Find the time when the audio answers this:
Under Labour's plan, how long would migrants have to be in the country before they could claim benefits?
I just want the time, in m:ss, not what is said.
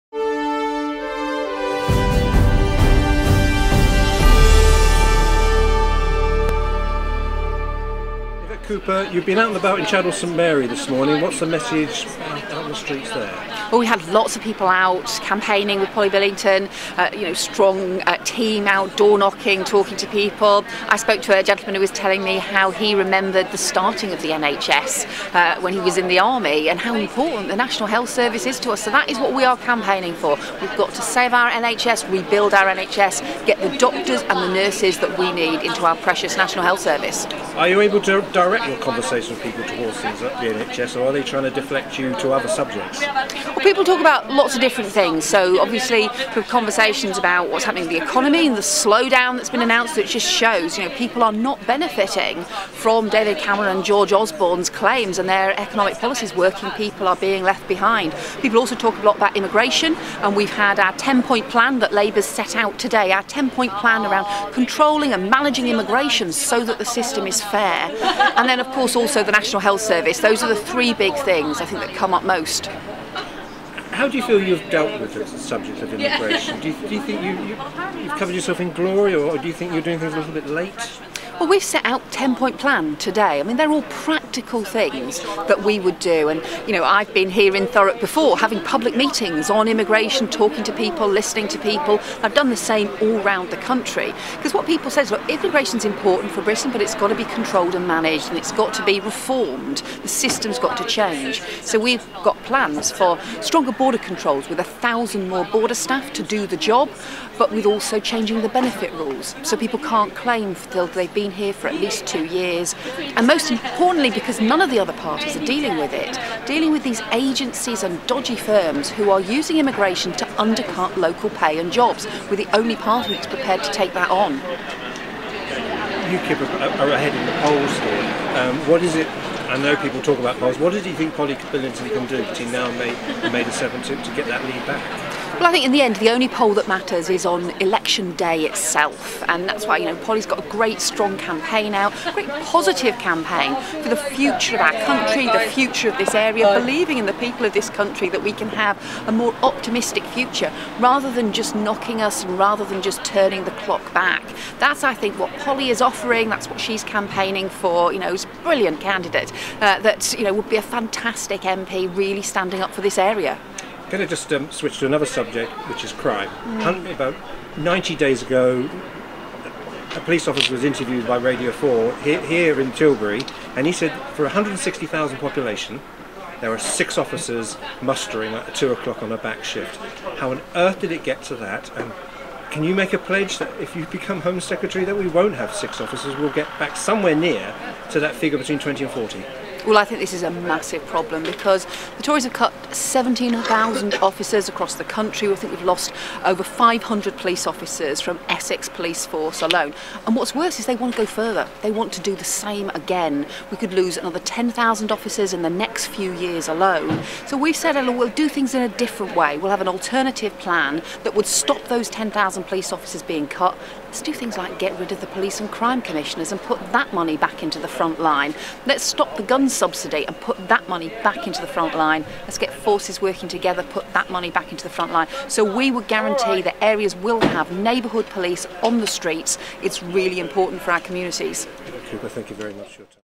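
1:52.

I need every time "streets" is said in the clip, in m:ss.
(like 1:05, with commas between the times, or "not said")
0:12, 3:48.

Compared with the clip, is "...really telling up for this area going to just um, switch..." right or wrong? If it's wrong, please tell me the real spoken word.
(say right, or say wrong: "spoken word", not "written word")
wrong: "standing", not "telling".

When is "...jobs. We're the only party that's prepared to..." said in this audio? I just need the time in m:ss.
2:01.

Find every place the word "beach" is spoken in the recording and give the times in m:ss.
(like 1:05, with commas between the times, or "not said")
not said.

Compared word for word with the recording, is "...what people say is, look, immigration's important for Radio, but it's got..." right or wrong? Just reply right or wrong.
wrong.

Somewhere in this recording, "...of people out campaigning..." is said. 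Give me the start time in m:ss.
0:14.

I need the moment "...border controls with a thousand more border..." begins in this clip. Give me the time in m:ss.
1:43.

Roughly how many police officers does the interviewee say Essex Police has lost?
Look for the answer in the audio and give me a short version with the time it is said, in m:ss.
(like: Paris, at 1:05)
500, at 3:16.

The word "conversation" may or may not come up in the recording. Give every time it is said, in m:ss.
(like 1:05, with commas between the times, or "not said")
0:38, 0:46.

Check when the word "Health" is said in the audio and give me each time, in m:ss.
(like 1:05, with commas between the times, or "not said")
0:27, 0:36, 1:09.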